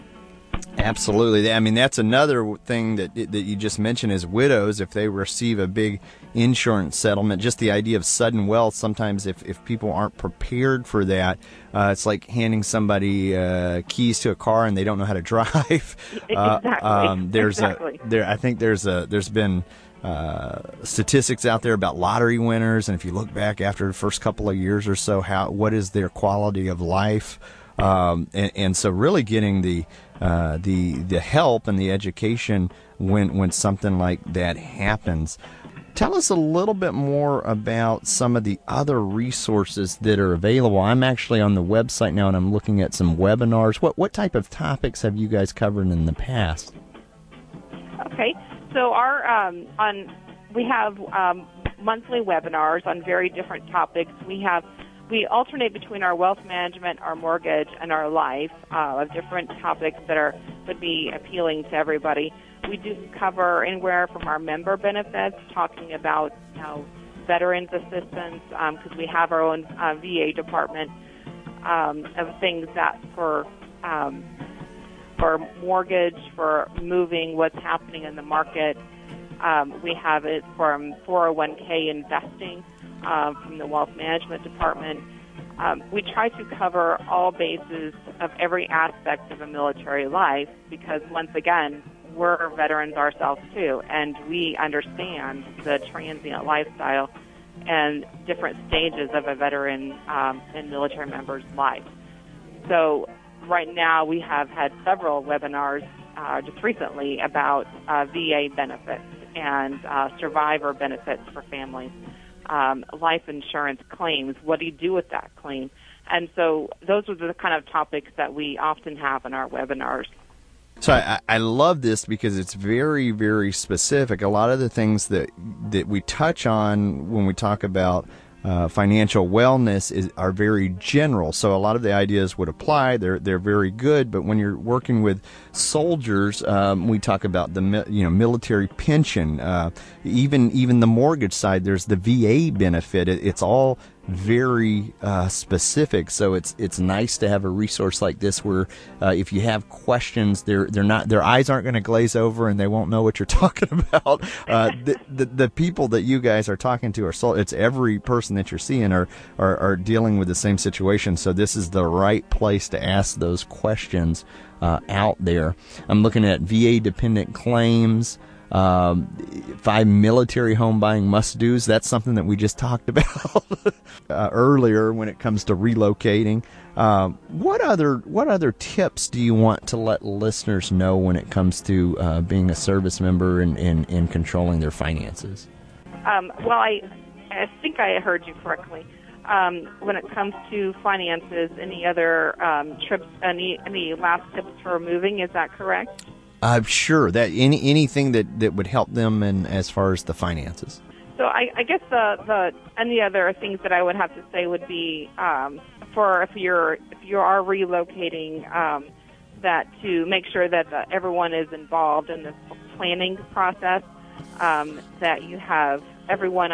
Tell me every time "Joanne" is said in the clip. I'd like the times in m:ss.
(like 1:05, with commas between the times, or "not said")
not said.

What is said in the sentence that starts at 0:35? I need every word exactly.
Tell us a little bit more about some of the other resources that are available.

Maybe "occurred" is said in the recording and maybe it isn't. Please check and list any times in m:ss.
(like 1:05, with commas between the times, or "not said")
not said.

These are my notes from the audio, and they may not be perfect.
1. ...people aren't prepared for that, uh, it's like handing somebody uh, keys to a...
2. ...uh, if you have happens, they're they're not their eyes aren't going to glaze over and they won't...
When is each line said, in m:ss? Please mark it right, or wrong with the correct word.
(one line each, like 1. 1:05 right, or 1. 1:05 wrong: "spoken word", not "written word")
1. 0:09 right
2. 2:29 wrong: "questions", not "happens".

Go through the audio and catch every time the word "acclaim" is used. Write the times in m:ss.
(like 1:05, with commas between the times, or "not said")
not said.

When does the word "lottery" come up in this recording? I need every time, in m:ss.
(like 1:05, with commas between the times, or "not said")
0:21.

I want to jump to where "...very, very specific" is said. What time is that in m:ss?
2:02.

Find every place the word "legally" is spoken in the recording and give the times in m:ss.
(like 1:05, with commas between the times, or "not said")
not said.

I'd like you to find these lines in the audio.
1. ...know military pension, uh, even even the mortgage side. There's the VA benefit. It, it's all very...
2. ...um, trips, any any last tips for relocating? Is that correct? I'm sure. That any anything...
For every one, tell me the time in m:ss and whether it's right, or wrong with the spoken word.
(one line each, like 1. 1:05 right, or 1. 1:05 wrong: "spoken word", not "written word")
1. 2:18 right
2. 3:12 wrong: "moving", not "relocating".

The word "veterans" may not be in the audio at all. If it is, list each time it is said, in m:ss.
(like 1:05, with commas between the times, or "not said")
1:07, 1:32, 1:39.